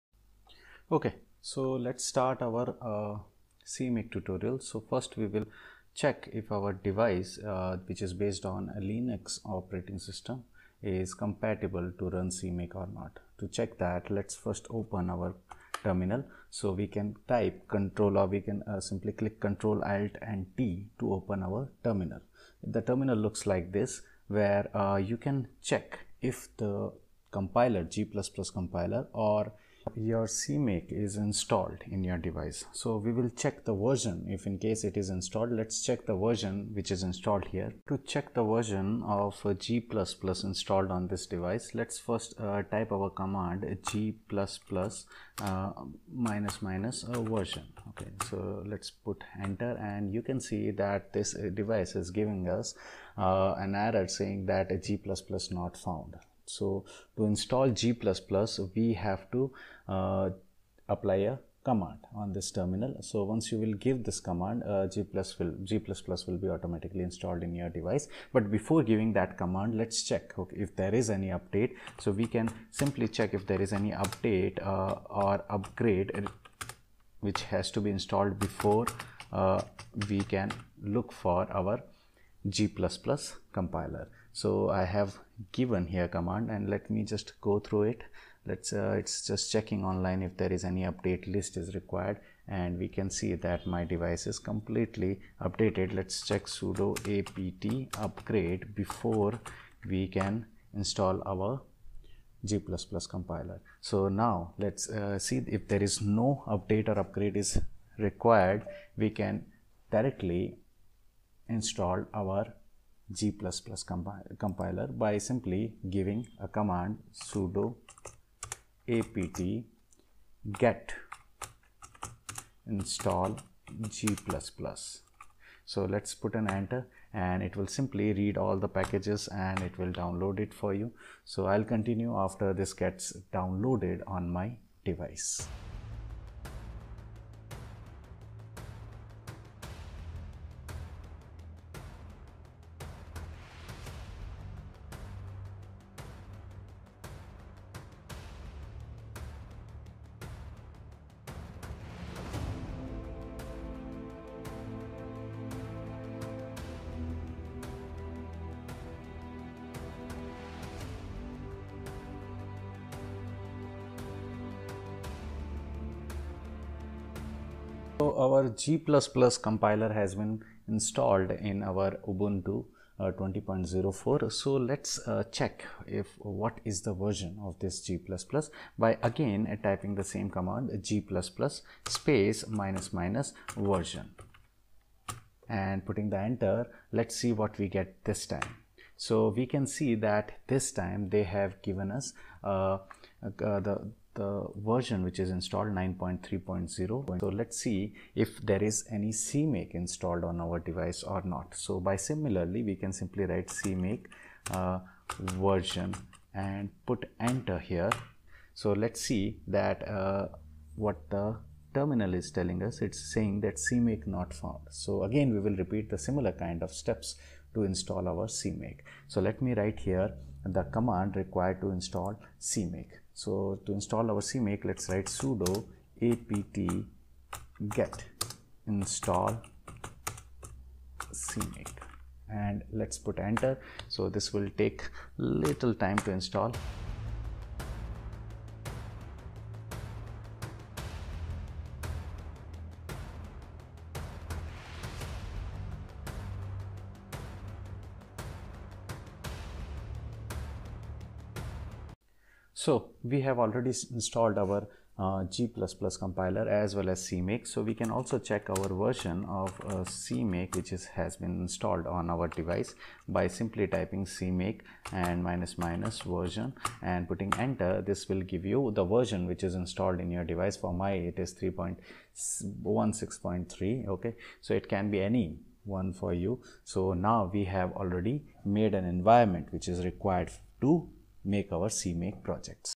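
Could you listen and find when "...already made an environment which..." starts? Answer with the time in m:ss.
4:37.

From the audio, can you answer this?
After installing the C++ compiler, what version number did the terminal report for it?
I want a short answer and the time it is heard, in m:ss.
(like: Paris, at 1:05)
9.3.0, at 3:15.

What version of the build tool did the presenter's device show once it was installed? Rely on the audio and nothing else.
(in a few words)
3.16.3.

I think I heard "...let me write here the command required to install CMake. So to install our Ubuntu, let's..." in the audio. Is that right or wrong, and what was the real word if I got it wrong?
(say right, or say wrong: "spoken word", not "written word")
wrong: "CMake", not "Ubuntu".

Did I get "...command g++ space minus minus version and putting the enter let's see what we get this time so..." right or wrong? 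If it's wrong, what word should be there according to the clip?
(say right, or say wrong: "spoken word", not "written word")
right.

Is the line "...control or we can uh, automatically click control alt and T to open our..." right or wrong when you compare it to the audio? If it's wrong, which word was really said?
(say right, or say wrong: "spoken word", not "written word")
wrong: "simply", not "automatically".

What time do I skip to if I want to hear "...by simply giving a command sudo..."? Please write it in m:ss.
1:54.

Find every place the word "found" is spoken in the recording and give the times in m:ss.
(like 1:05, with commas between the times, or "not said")
0:55, 3:34.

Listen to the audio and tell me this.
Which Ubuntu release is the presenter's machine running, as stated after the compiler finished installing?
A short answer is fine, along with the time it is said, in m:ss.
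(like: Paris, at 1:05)
20.04, at 2:53.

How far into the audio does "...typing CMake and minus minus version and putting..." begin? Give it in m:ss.
4:23.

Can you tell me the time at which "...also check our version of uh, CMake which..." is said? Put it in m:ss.
4:17.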